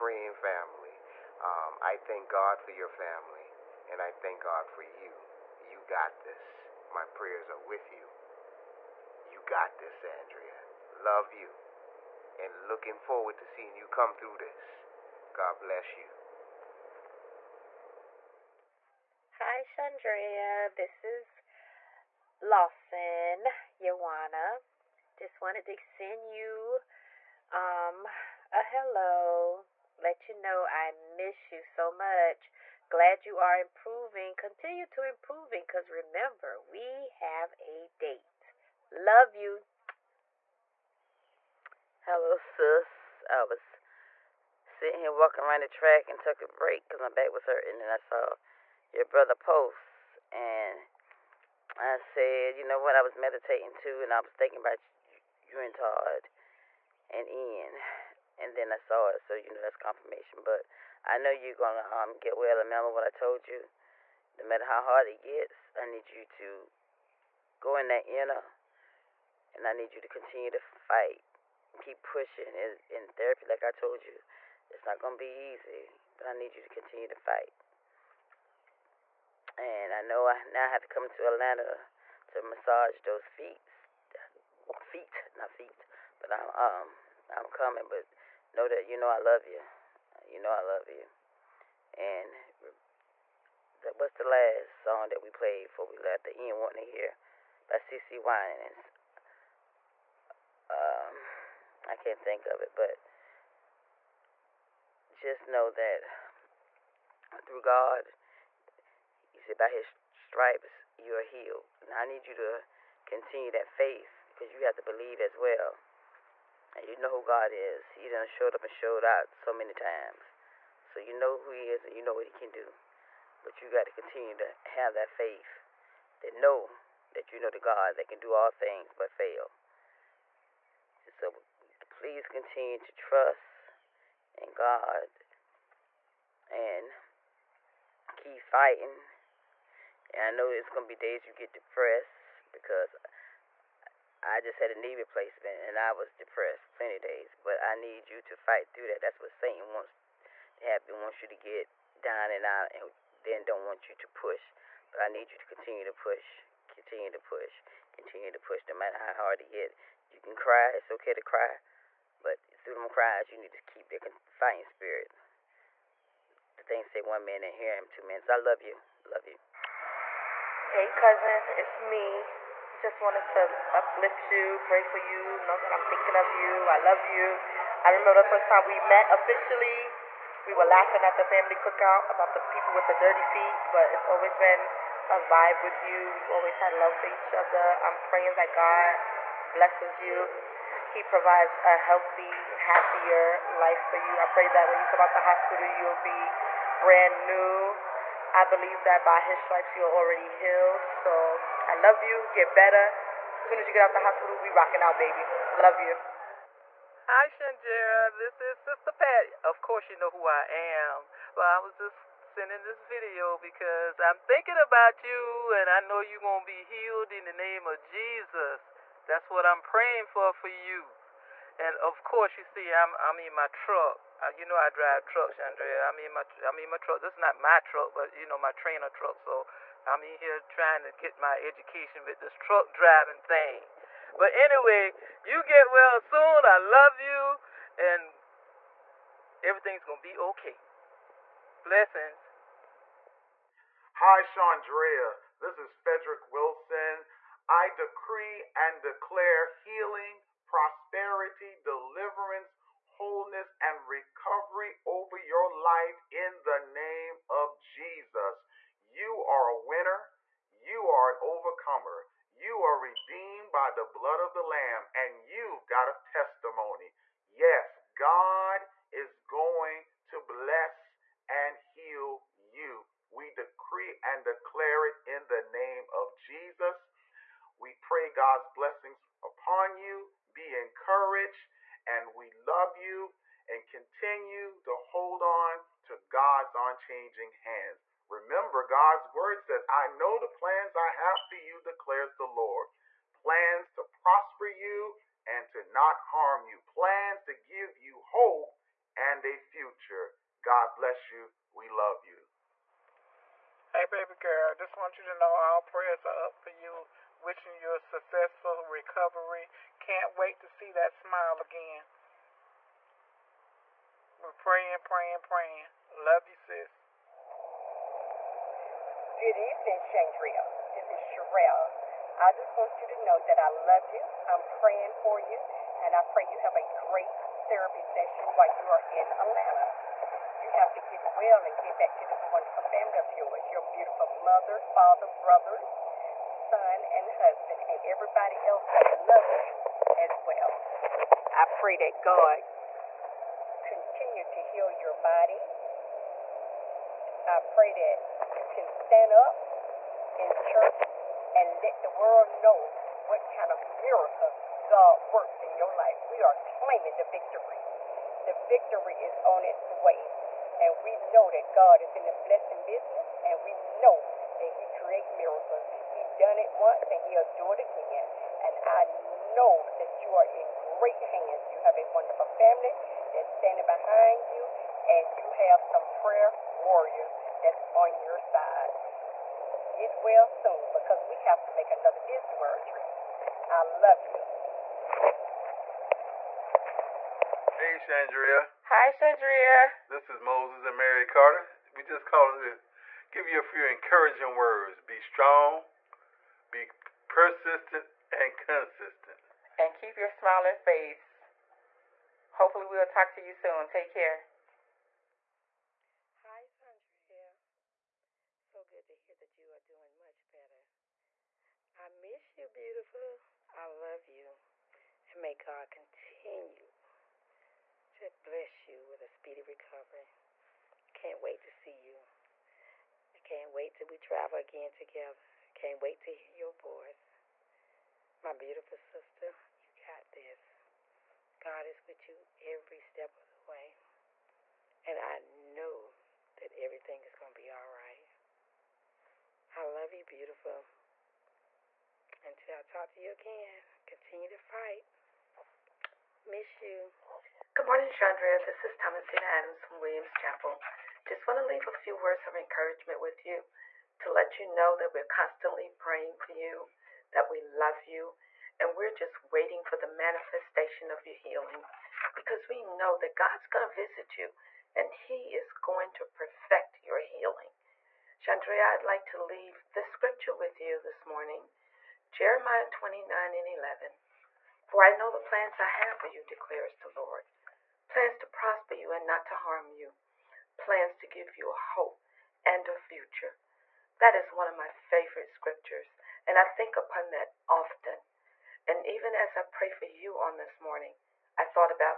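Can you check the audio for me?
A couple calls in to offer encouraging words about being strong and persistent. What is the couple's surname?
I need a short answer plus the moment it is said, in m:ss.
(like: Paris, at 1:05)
Carter, at 6:30.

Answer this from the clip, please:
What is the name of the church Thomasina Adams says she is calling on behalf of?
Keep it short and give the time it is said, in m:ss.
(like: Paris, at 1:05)
Williams Chapel, at 7:29.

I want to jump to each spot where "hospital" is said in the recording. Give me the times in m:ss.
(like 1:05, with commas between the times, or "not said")
3:15, 3:24.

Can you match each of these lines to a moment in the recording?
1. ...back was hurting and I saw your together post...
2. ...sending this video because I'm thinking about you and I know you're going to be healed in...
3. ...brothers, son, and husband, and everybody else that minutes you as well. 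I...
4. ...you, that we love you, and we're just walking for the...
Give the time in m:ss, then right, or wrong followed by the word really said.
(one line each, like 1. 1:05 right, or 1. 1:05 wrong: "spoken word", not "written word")
1. 0:47 wrong: "brother", not "together"
2. 3:32 right
3. 5:35 wrong: "loves", not "minutes"
4. 7:36 wrong: "waiting", not "walking".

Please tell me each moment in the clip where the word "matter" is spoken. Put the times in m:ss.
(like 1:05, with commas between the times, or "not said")
1:04, 2:38.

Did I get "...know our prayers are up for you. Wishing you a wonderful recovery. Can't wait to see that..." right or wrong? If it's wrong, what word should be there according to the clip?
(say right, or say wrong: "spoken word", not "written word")
wrong: "successful", not "wonderful".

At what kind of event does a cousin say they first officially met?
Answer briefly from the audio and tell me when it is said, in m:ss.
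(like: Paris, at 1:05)
Family cookout, at 3:01.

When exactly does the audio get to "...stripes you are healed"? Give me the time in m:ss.
1:50.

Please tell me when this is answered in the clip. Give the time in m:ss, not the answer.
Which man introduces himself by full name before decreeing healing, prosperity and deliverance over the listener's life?
4:05.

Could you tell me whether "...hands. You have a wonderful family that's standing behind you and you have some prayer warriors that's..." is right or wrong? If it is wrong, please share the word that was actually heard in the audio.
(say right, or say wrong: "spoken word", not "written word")
right.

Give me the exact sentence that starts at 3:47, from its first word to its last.
This is not my truck, but you know my trainer truck.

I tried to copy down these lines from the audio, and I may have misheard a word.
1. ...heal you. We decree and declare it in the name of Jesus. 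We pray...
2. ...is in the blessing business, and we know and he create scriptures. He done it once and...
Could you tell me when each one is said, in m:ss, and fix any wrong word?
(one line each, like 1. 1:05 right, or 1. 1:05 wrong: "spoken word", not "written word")
1. 4:31 right
2. 6:01 wrong: "miracles", not "scriptures".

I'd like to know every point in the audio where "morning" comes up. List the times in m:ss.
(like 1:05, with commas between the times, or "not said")
7:27, 7:51, 8:10.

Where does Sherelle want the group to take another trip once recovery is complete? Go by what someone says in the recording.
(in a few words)
Disney World.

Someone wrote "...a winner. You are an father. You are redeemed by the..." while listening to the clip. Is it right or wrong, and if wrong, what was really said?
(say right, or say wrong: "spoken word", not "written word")
wrong: "overcomer", not "father".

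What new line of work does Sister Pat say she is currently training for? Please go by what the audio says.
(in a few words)
Truck driving.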